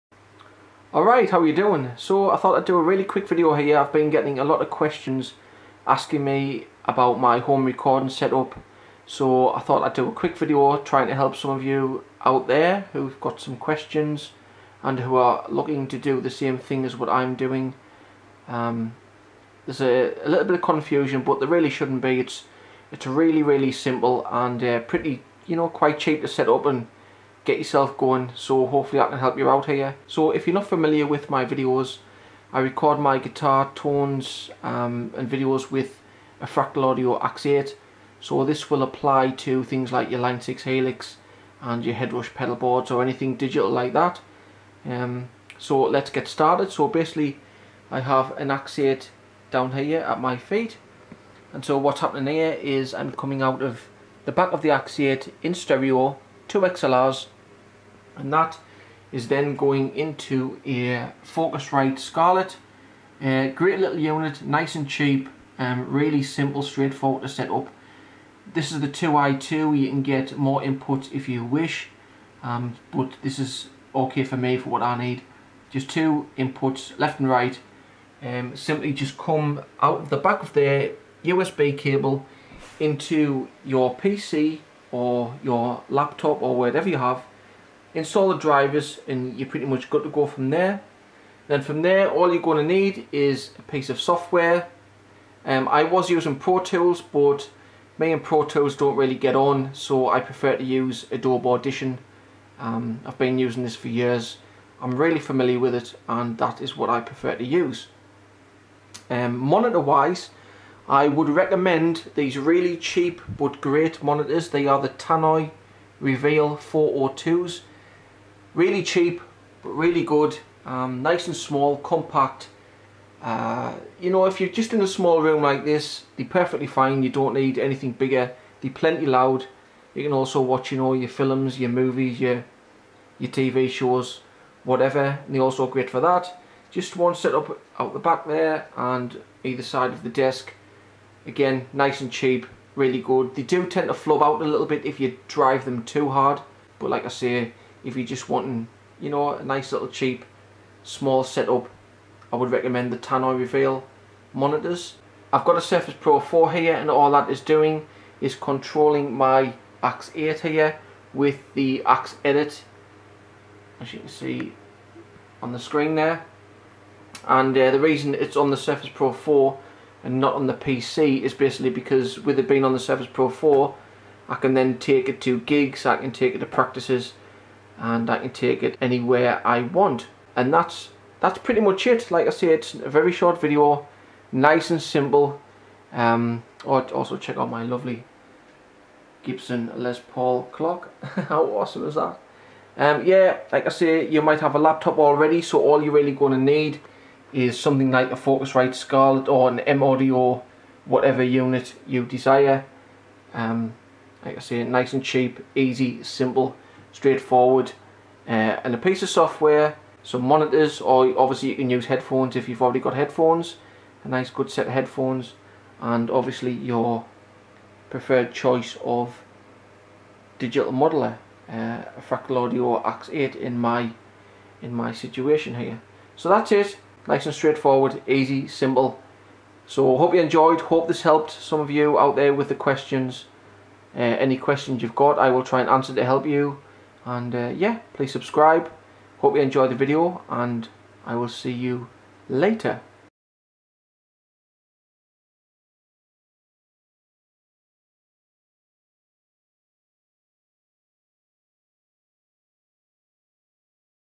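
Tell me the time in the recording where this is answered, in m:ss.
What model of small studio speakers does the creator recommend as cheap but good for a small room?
1:54.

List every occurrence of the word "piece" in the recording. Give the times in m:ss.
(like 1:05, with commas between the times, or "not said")
1:33, 3:28.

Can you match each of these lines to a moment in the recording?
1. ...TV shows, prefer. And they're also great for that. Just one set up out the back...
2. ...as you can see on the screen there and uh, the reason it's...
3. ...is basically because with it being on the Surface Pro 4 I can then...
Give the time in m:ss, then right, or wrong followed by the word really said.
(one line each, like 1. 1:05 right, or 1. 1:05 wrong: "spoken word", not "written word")
1. 2:13 wrong: "whatever", not "prefer"
2. 2:43 right
3. 2:51 right.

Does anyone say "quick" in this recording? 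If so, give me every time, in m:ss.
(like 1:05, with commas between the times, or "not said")
0:03, 0:10.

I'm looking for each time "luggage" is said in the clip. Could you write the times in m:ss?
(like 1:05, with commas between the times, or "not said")
not said.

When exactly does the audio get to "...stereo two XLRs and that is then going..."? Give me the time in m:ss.
0:55.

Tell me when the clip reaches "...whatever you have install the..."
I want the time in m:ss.
1:26.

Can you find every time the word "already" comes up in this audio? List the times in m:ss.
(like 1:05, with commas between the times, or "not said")
3:14, 3:32.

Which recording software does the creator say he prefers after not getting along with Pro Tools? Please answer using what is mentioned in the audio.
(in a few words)
Adobe Audition.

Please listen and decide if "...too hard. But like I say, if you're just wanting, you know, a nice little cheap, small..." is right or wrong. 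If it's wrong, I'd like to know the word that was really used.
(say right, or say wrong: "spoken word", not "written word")
right.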